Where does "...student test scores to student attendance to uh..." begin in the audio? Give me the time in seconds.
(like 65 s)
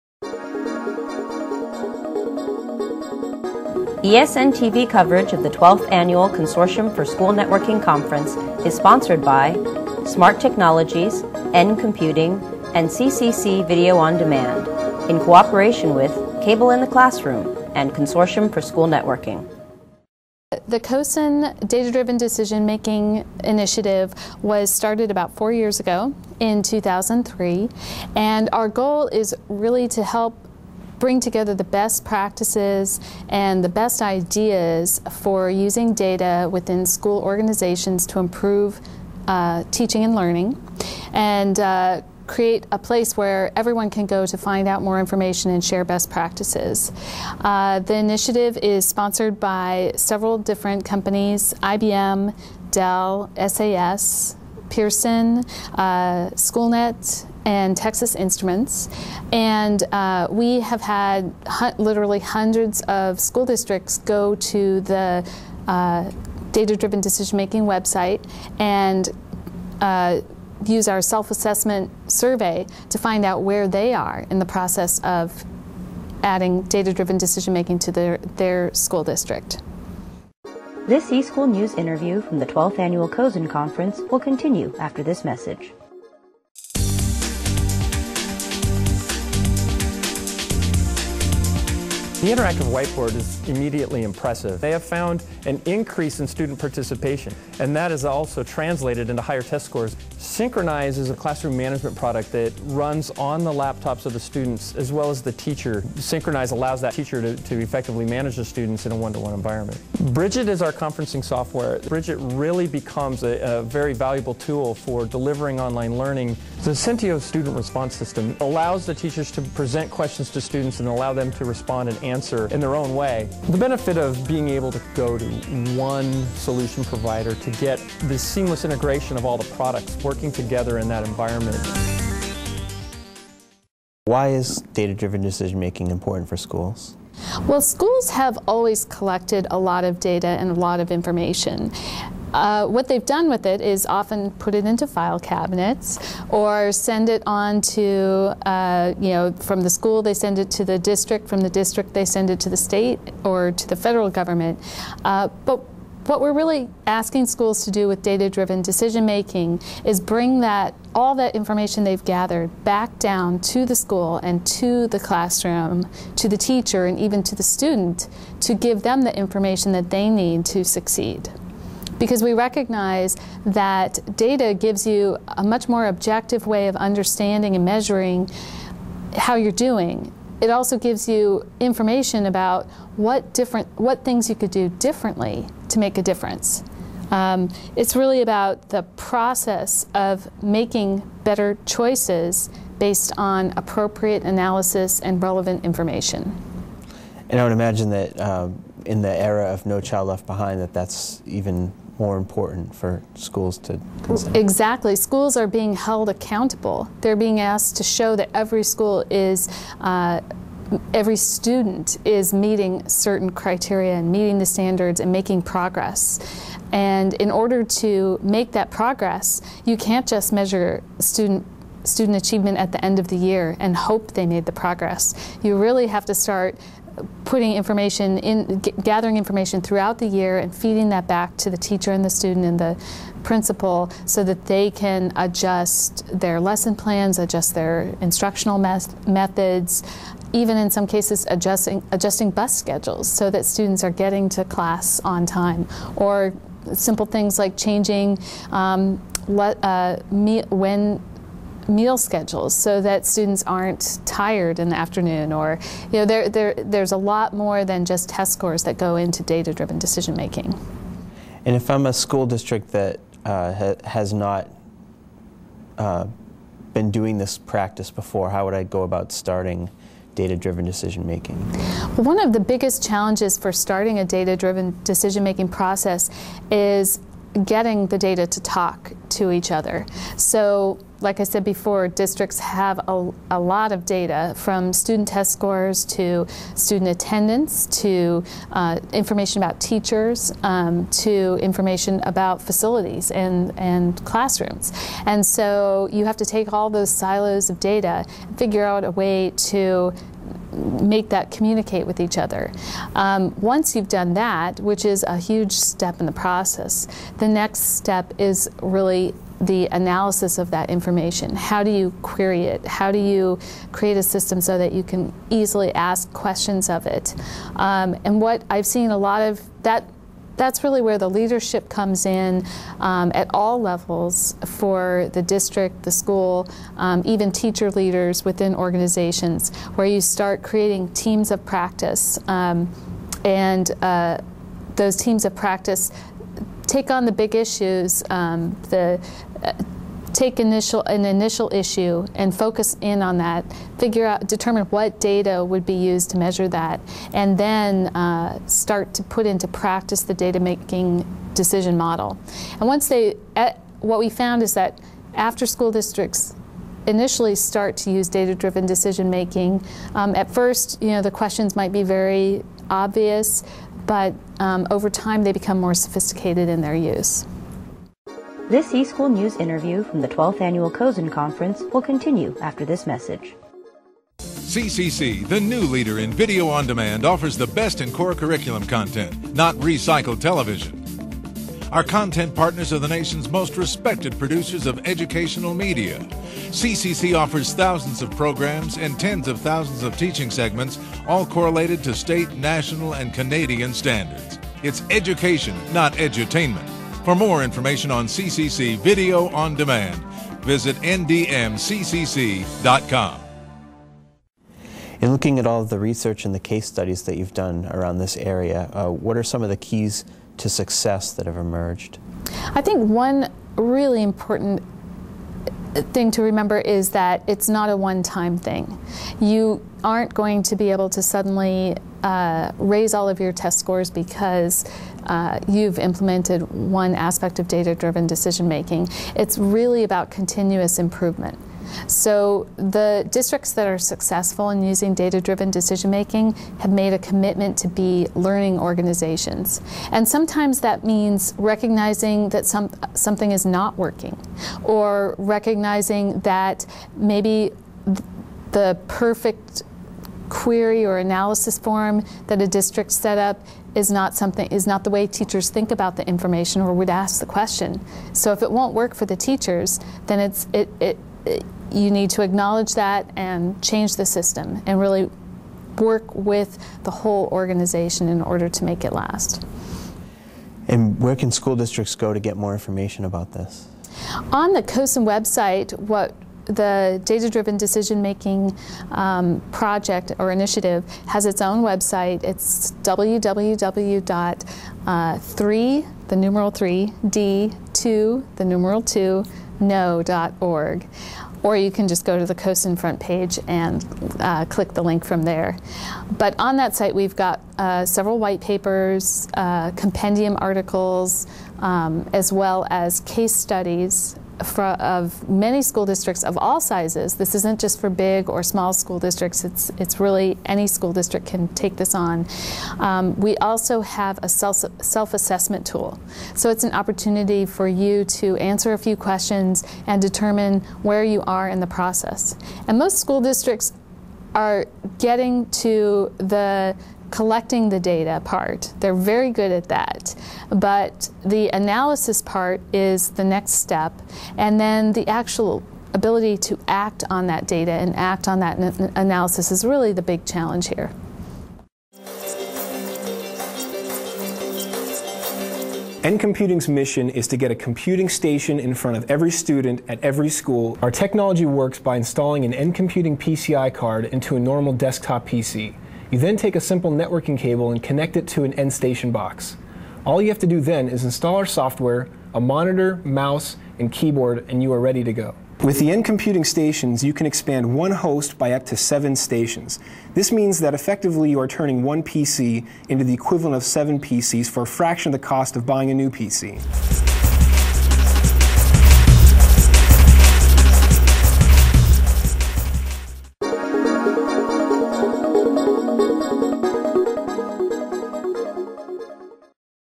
284 s.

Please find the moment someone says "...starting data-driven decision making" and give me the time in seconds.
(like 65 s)
269 s.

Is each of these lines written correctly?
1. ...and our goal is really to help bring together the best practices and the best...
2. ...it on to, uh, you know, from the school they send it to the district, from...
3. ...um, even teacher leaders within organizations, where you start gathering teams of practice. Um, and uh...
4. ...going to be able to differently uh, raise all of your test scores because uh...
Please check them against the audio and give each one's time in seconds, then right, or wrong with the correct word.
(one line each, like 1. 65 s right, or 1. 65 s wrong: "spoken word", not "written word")
1. 28 s right
2. 147 s right
3. 326 s wrong: "creating", not "gathering"
4. 420 s wrong: "suddenly", not "differently".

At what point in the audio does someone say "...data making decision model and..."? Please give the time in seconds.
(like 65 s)
350 s.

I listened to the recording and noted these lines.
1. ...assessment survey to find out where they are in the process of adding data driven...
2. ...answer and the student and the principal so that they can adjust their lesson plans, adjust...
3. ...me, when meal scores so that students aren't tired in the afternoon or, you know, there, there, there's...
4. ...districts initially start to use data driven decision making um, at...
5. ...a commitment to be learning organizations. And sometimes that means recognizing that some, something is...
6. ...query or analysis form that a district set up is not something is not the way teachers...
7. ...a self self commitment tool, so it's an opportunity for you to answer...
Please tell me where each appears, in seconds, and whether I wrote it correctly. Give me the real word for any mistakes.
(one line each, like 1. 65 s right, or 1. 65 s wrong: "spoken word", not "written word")
1. 71 s right
2. 231 s wrong: "teacher", not "answer"
3. 250 s wrong: "schedules", not "scores"
4. 355 s right
5. 436 s right
6. 450 s right
7. 514 s wrong: "assessment", not "commitment".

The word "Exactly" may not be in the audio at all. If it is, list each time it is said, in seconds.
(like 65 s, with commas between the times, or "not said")
204 s.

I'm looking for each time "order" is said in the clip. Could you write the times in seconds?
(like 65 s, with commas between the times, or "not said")
217 s, 468 s.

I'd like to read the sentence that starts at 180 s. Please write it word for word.
It also gives you information about what different what things you could do differently to make a difference.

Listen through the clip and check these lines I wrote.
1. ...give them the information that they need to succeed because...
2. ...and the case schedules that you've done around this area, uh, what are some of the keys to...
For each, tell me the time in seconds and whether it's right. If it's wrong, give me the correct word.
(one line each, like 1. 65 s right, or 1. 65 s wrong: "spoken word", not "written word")
1. 168 s right
2. 406 s wrong: "studies", not "schedules".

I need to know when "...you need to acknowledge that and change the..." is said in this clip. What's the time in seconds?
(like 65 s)
461 s.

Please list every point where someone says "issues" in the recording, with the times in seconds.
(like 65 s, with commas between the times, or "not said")
337 s, 341 s.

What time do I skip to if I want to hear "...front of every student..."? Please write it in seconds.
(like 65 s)
548 s.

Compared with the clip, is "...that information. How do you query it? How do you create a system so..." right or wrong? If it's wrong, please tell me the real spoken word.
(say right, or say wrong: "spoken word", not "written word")
right.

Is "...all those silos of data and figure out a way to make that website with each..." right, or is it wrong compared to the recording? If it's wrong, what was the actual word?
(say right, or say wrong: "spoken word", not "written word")
wrong: "communicate", not "website".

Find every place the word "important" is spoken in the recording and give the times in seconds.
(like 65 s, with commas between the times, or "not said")
135 s, 202 s, 414 s.